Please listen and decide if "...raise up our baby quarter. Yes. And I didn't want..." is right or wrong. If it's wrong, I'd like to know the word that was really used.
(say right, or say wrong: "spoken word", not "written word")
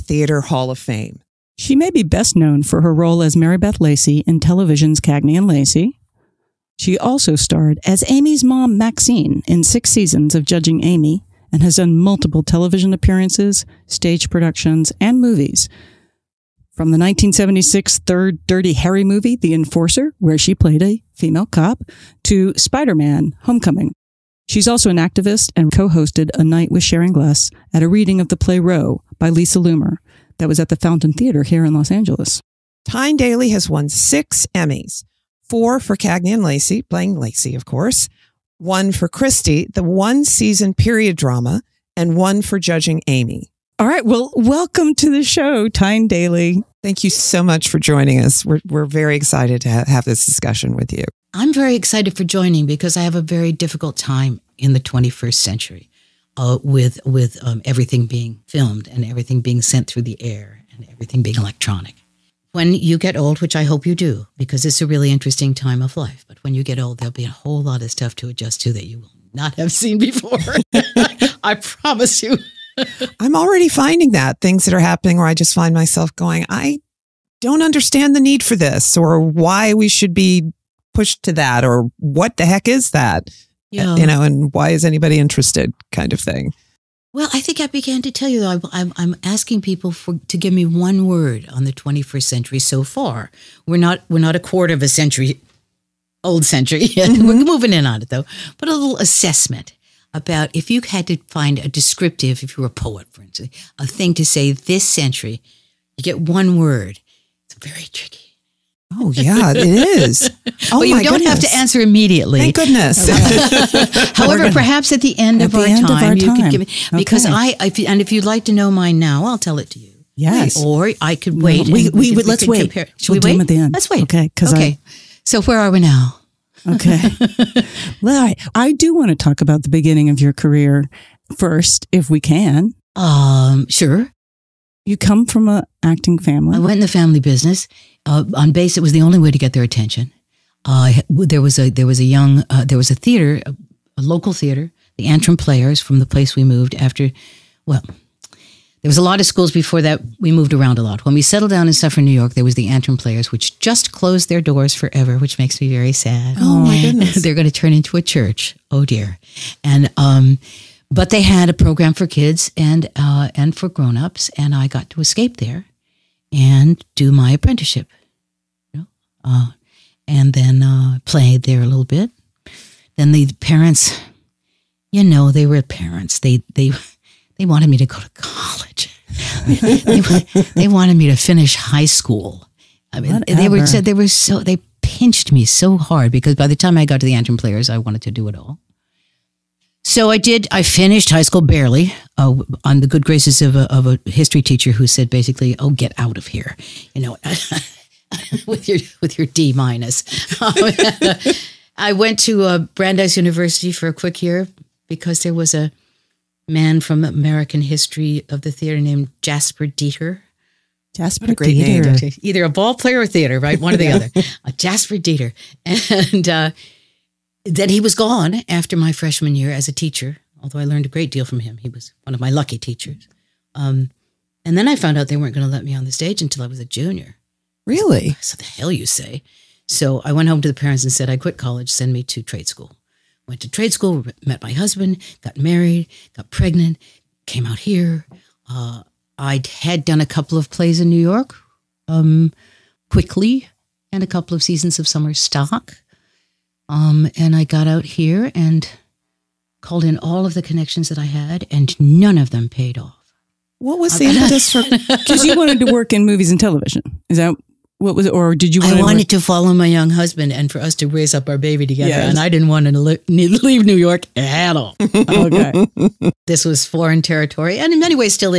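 wrong: "together", not "quarter".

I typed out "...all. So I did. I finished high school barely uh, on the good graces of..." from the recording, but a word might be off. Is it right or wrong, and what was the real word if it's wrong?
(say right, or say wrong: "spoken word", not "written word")
right.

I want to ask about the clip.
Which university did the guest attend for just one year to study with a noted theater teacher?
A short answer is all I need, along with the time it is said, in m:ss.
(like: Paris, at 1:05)
Brandeis University, at 3:22.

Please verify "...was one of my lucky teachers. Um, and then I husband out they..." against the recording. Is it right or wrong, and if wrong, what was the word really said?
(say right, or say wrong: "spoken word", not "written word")
wrong: "found", not "husband".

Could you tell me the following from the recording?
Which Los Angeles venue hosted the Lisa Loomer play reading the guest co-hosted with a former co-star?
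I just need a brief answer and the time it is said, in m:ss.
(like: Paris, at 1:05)
Fountain Theater, at 0:30.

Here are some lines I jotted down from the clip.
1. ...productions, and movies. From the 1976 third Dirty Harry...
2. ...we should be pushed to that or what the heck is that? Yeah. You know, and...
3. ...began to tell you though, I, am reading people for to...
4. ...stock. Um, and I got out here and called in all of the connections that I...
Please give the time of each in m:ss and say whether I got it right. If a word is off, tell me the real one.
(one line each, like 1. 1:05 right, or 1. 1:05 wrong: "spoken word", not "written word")
1. 0:14 right
2. 1:19 right
3. 1:27 wrong: "asking", not "reading"
4. 4:05 right.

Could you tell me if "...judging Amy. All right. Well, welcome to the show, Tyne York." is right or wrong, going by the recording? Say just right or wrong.
wrong.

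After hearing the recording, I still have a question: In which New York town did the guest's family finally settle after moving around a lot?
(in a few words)
Suffern, New York.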